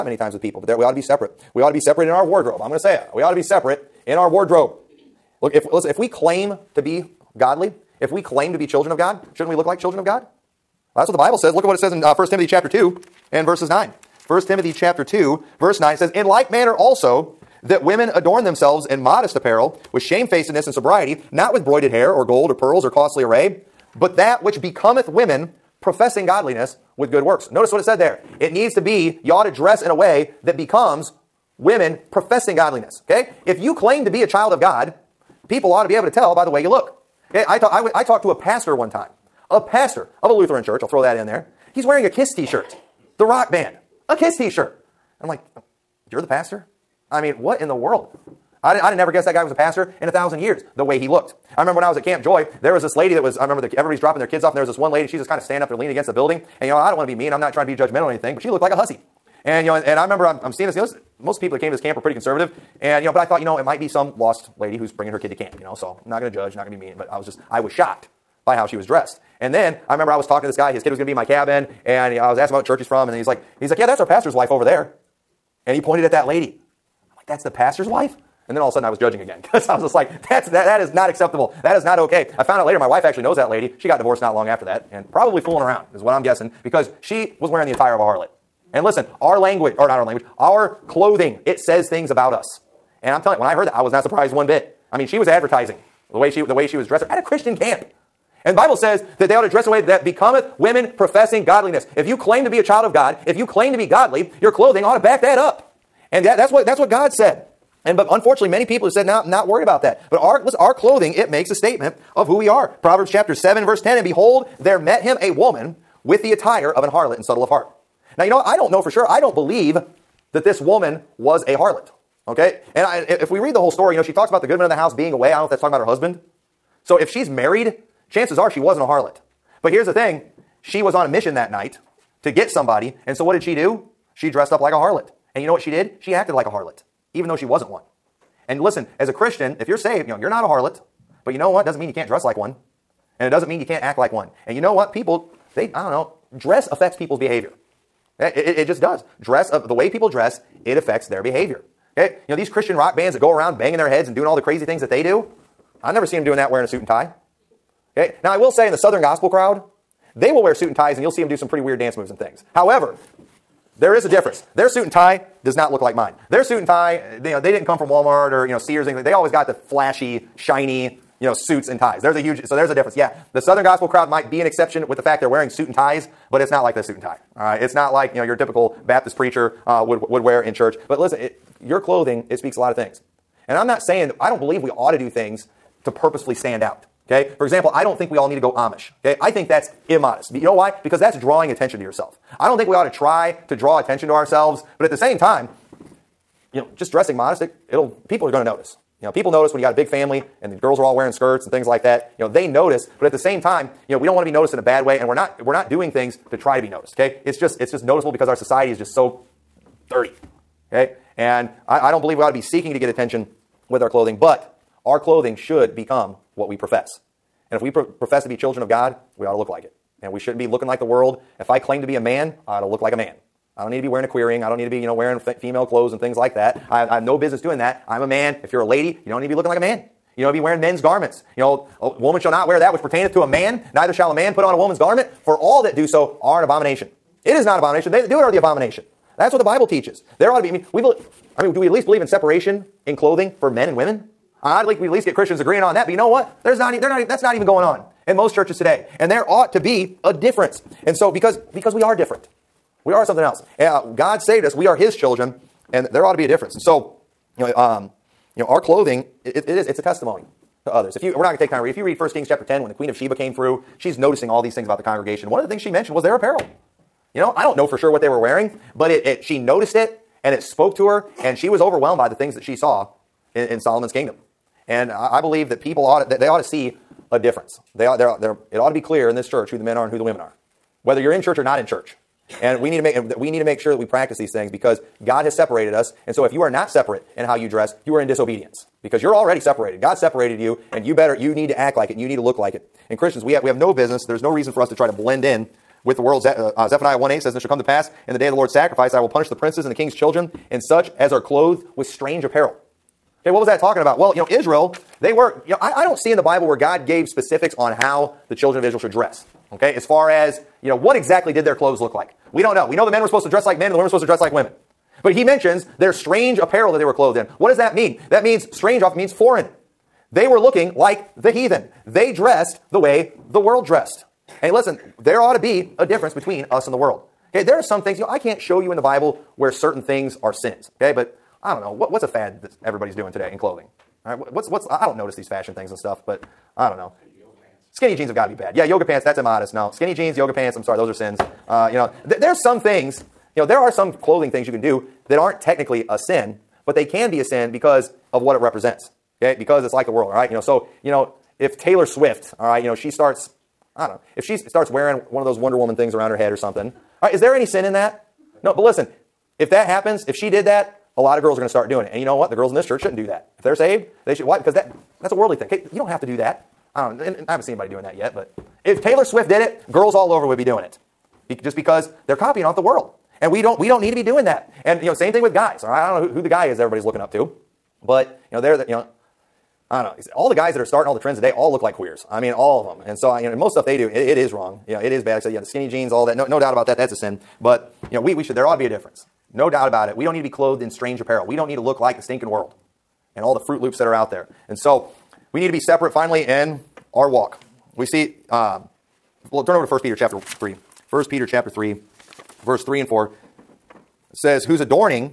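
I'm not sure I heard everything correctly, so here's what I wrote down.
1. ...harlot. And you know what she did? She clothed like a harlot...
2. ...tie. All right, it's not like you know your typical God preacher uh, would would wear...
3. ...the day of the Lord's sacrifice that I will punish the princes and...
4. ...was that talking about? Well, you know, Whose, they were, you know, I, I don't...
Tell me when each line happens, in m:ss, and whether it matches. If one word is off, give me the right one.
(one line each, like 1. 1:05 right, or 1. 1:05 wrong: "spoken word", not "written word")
1. 2:14 wrong: "acted", not "clothed"
2. 2:57 wrong: "Baptist", not "God"
3. 4:58 right
4. 5:03 wrong: "Israel", not "Whose".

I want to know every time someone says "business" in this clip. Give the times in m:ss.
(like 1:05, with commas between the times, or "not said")
3:47, 4:53.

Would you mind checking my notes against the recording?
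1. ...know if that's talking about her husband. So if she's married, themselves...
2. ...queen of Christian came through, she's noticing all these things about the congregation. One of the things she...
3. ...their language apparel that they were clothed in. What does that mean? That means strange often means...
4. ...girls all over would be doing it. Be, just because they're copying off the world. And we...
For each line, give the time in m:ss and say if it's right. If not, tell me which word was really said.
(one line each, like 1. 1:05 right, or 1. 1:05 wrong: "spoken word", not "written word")
1. 2:05 wrong: "chances", not "themselves"
2. 4:22 wrong: "Sheba", not "Christian"
3. 5:15 wrong: "strange", not "language"
4. 6:09 right.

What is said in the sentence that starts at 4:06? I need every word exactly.
There's not, they're not, that's not even going on in most churches today.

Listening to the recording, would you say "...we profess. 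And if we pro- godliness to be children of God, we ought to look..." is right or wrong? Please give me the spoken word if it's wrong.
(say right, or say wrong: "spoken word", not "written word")
wrong: "profess", not "godliness".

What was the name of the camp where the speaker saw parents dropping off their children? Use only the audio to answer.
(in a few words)
Camp Joy.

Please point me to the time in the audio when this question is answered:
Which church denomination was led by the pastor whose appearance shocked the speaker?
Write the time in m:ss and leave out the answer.
0:40.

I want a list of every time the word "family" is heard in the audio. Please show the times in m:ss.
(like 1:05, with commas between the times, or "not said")
3:19.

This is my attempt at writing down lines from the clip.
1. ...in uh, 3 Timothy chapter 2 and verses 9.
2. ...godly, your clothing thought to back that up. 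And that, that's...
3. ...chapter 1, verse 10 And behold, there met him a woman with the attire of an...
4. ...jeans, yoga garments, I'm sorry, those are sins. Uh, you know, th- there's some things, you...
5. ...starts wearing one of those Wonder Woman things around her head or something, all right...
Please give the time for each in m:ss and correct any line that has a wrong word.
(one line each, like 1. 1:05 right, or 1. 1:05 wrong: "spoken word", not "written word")
1. 0:11 wrong: "1", not "3"
2. 1:43 wrong: "ought", not "thought"
3. 1:53 wrong: "7", not "1"
4. 5:39 wrong: "pants", not "garments"
5. 5:54 right.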